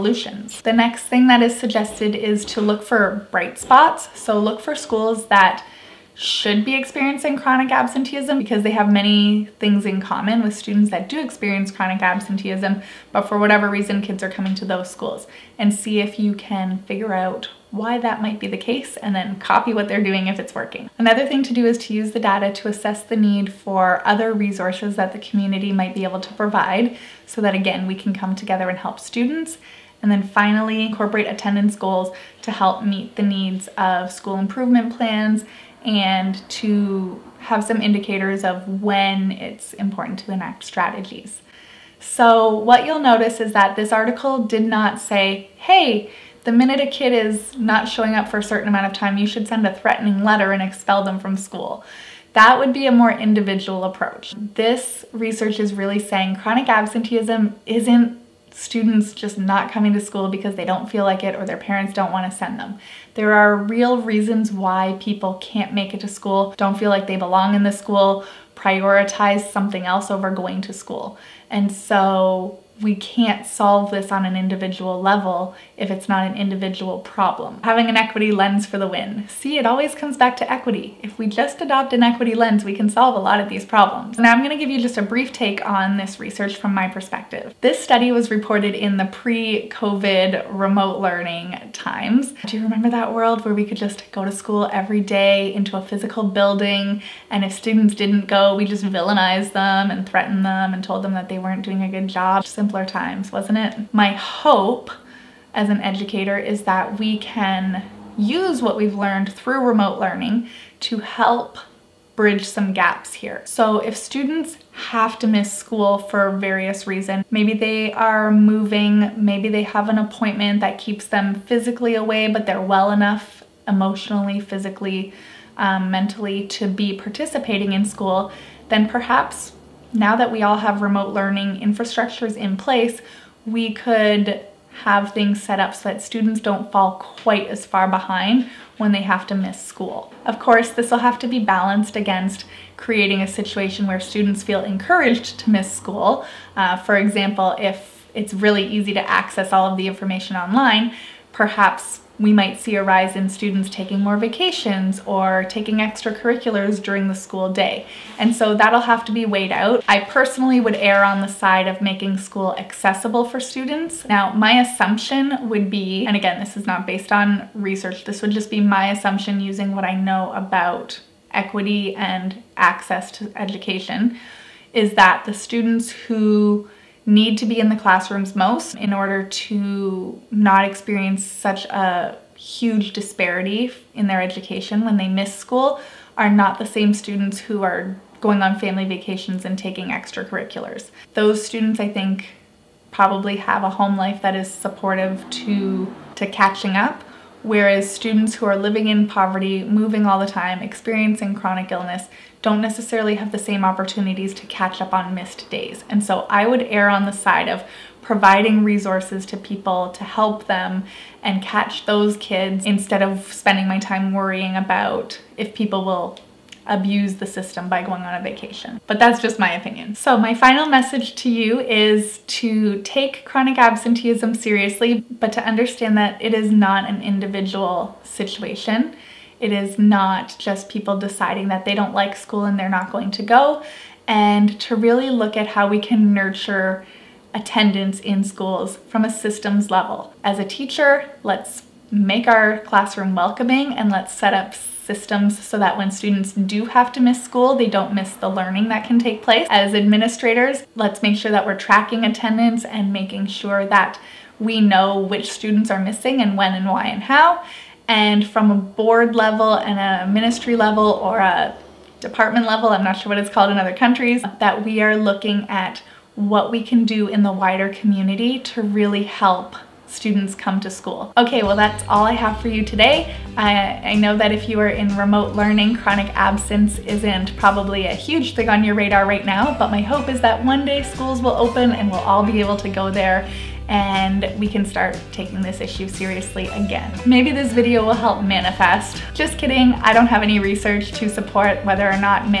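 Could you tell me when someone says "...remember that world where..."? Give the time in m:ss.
1:32.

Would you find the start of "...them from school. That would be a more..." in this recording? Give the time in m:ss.
0:51.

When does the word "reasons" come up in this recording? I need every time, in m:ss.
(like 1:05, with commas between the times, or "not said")
0:13, 1:03, 1:56.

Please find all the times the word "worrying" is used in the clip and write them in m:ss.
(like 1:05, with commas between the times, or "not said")
3:34.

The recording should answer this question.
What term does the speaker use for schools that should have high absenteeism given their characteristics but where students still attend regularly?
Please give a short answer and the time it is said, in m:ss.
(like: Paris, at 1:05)
Bright spots, at 0:03.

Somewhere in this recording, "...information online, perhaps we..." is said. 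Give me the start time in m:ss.
2:29.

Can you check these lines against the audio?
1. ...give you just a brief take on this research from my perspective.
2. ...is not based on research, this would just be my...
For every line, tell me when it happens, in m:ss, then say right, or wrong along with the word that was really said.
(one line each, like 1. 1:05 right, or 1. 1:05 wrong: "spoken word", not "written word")
1. 1:24 right
2. 2:46 right.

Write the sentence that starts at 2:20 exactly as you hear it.
Of course, this will have to be balanced against creating a situation where students feel encouraged to miss school.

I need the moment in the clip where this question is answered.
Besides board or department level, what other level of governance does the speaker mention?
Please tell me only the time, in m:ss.
4:20.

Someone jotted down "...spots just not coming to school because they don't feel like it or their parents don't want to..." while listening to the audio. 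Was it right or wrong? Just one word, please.
wrong.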